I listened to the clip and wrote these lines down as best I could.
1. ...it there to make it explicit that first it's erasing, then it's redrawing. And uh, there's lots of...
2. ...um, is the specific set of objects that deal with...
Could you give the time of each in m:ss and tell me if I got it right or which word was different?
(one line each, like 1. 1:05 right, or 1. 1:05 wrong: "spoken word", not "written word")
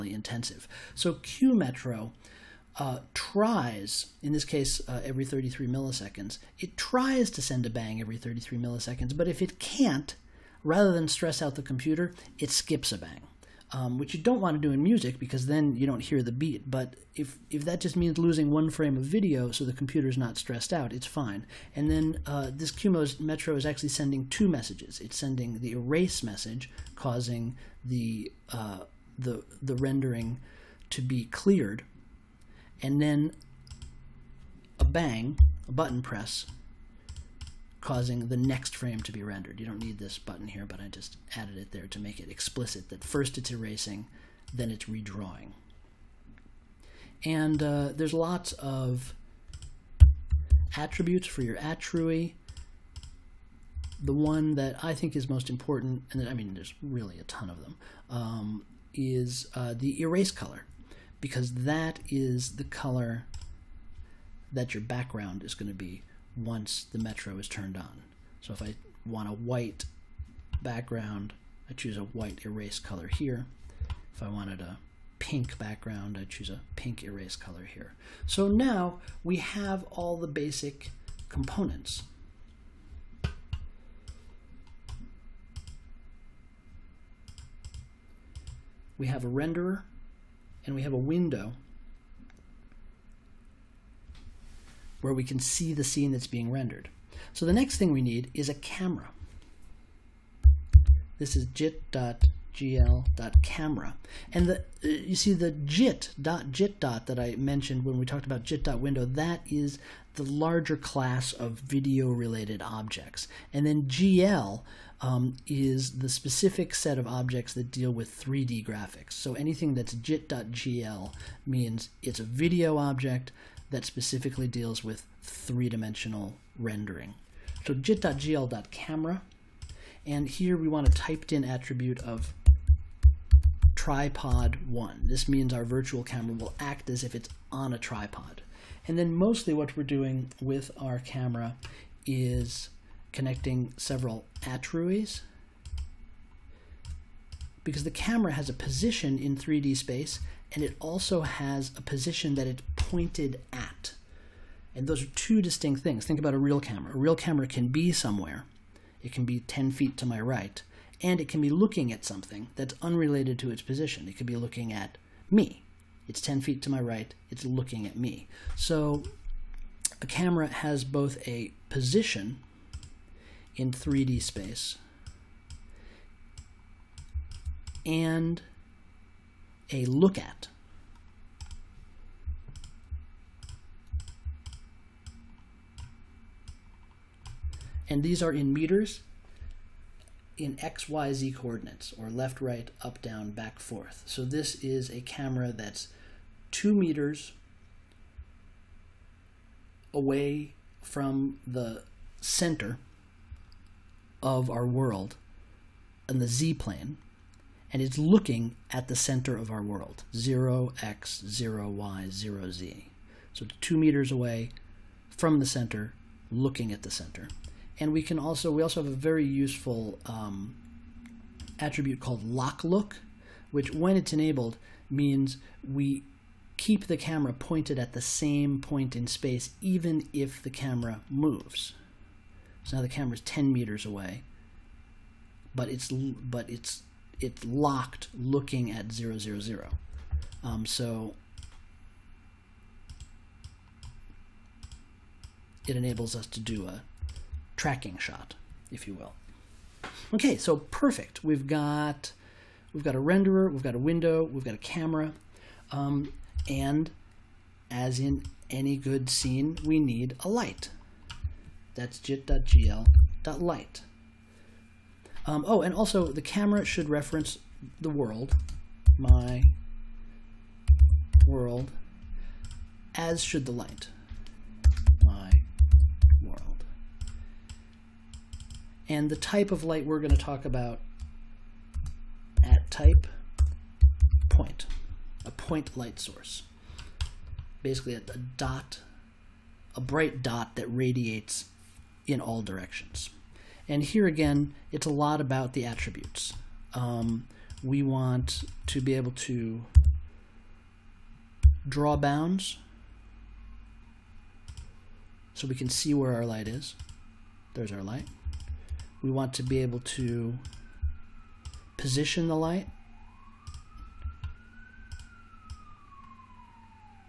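1. 0:41 right
2. 1:54 right.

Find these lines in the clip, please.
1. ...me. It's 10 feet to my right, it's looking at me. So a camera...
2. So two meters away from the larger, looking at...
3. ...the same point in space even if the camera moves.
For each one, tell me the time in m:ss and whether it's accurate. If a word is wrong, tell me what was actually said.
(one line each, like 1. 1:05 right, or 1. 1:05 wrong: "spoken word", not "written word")
1. 2:45 right
2. 3:33 wrong: "center", not "larger"
3. 3:47 right.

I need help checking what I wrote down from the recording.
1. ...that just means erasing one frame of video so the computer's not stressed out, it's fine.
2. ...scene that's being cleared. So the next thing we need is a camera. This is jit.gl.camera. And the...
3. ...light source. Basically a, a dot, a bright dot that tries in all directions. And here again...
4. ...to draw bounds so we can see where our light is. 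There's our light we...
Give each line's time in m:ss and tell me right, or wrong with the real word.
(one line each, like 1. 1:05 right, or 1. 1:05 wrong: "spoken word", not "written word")
1. 0:17 wrong: "losing", not "erasing"
2. 1:35 wrong: "rendered", not "cleared"
3. 4:45 wrong: "radiates", not "tries"
4. 4:59 right.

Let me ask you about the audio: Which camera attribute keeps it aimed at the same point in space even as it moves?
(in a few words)
lock look.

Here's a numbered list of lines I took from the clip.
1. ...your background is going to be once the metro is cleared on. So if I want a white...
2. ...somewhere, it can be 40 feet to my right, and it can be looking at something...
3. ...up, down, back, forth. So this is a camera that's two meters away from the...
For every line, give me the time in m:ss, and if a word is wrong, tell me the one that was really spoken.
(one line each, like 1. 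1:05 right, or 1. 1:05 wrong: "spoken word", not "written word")
1. 1:04 wrong: "turned", not "cleared"
2. 2:37 wrong: "10", not "40"
3. 3:12 right.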